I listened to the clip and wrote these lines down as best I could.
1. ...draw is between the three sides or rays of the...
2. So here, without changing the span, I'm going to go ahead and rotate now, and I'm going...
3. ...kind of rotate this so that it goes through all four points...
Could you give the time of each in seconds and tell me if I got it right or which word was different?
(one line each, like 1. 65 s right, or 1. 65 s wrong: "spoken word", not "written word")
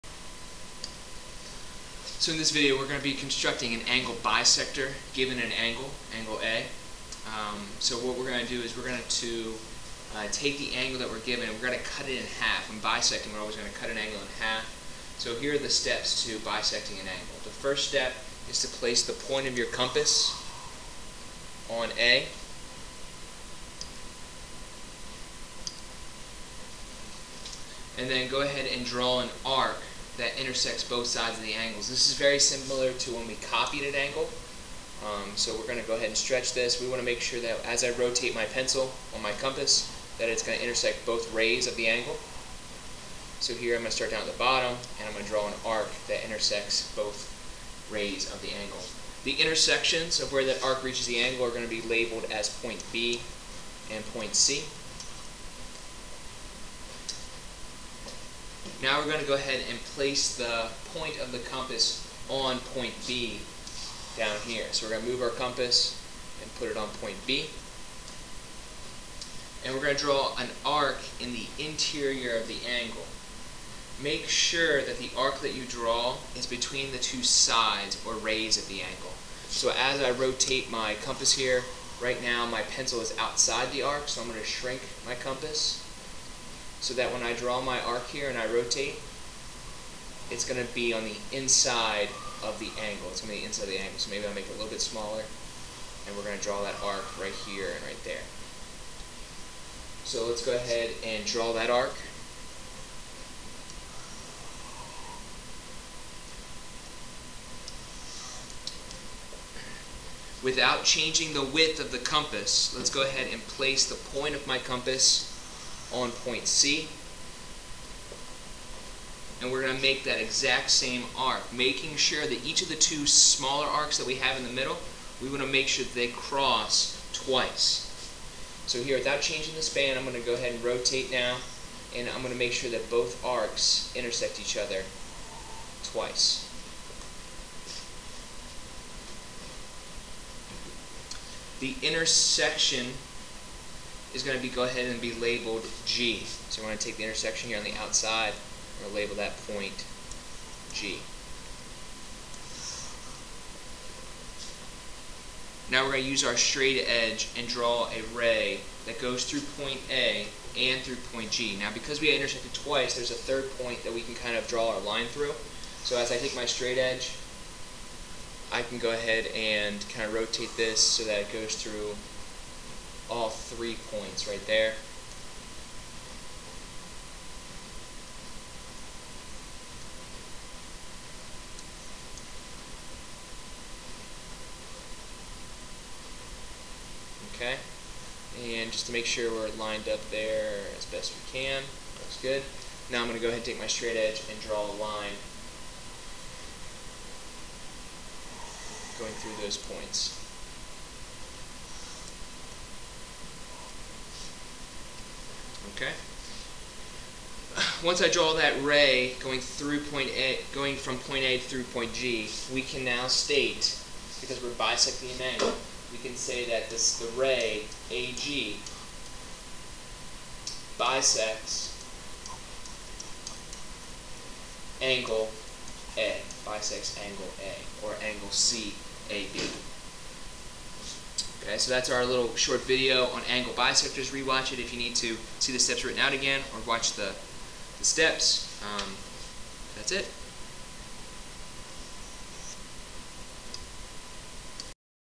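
1. 75 s wrong: "two", not "three"
2. 128 s right
3. 169 s wrong: "three", not "four".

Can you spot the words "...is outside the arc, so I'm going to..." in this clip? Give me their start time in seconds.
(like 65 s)
83 s.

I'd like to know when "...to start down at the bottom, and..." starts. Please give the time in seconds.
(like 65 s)
43 s.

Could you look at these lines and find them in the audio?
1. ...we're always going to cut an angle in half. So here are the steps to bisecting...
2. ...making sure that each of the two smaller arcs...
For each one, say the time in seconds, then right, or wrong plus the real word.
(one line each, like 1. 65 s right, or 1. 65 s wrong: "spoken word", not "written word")
1. 13 s right
2. 121 s right.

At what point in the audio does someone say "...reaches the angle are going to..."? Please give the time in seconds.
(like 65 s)
50 s.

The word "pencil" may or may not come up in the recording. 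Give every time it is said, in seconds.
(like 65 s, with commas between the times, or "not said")
38 s, 82 s.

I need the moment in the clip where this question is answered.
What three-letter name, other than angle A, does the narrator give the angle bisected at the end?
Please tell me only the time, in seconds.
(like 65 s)
228 s.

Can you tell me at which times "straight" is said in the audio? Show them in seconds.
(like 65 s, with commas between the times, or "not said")
156 s, 166 s, 193 s.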